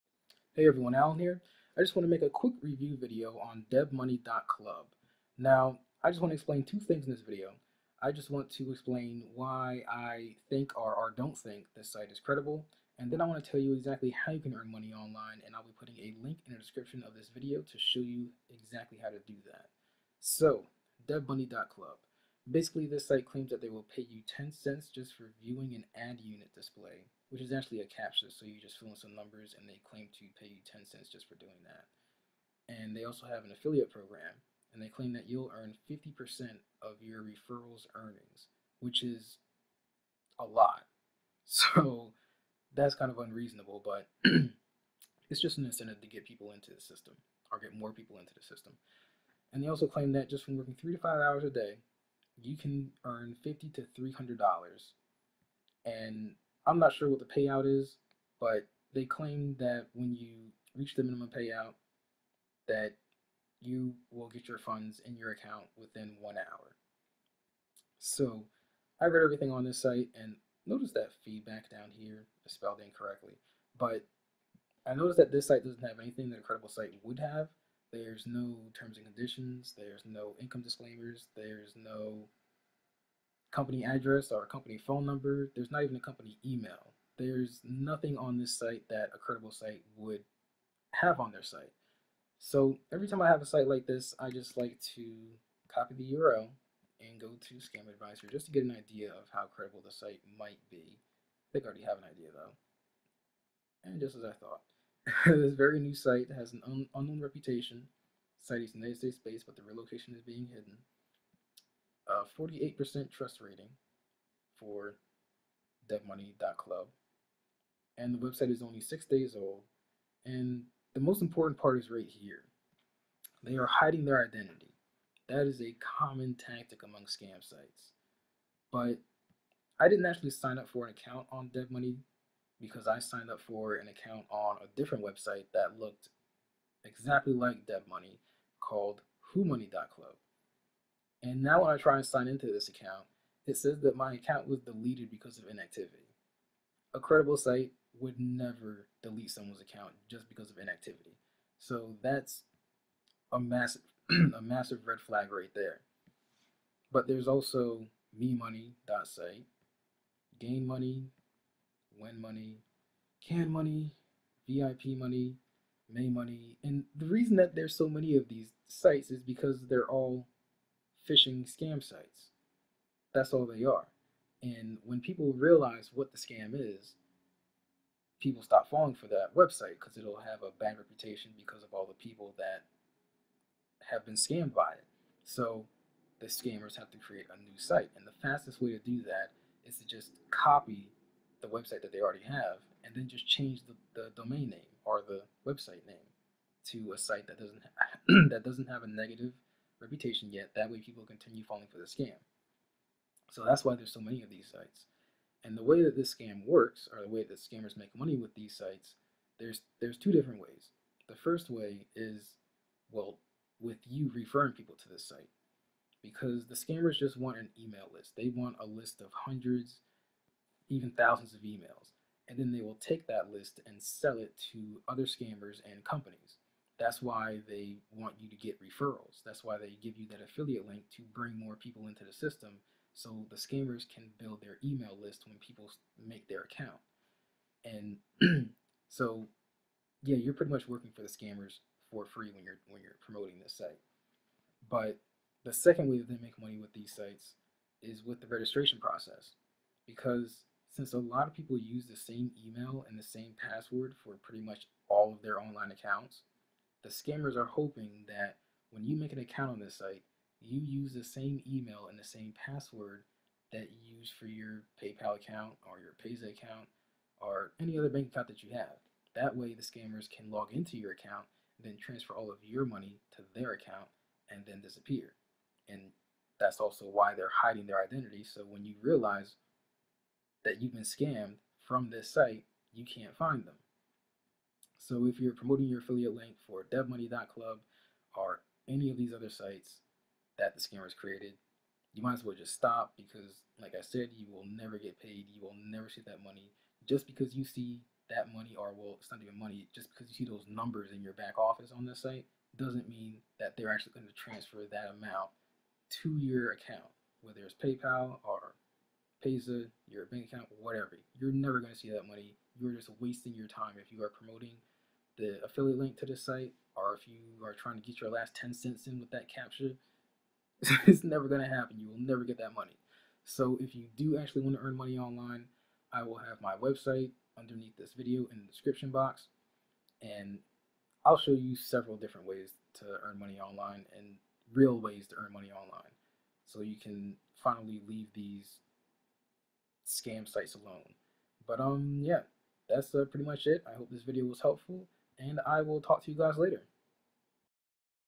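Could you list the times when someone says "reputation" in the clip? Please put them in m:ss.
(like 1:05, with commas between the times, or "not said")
1:47, 3:00, 3:19.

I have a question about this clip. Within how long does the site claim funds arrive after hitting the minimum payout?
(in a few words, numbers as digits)
1 hour.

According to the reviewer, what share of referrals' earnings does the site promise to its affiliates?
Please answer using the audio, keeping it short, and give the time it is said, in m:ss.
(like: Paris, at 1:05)
50%, at 0:35.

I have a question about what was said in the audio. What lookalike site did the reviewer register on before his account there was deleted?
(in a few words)
WhoMoney.club.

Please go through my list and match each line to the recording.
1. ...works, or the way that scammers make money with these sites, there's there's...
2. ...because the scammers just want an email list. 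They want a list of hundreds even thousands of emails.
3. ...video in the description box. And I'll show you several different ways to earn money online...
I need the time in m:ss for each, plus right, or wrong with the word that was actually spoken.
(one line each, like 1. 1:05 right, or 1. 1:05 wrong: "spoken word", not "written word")
1. 3:26 right
2. 3:36 right
3. 5:27 right.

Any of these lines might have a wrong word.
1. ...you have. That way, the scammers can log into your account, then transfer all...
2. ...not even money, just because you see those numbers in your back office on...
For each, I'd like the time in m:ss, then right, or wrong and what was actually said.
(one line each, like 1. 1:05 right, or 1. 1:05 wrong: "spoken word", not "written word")
1. 4:28 right
2. 4:59 right.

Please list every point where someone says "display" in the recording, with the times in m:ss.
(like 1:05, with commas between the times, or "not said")
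0:26.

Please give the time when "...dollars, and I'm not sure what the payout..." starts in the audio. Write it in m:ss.
0:54.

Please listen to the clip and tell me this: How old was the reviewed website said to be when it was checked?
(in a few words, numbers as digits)
6 days.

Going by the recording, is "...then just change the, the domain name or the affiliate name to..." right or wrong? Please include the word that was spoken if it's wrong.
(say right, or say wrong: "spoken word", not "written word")
wrong: "website", not "affiliate".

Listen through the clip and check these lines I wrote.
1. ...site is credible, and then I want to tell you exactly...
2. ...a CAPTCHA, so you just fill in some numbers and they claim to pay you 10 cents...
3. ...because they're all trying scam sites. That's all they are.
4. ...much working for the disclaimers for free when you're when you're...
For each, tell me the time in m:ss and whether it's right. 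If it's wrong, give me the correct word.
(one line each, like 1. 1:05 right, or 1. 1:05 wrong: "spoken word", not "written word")
1. 0:11 right
2. 0:27 right
3. 2:49 wrong: "phishing", not "trying"
4. 4:00 wrong: "scammers", not "disclaimers".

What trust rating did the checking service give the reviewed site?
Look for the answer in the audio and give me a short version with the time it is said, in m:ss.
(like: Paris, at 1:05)
48%, at 1:52.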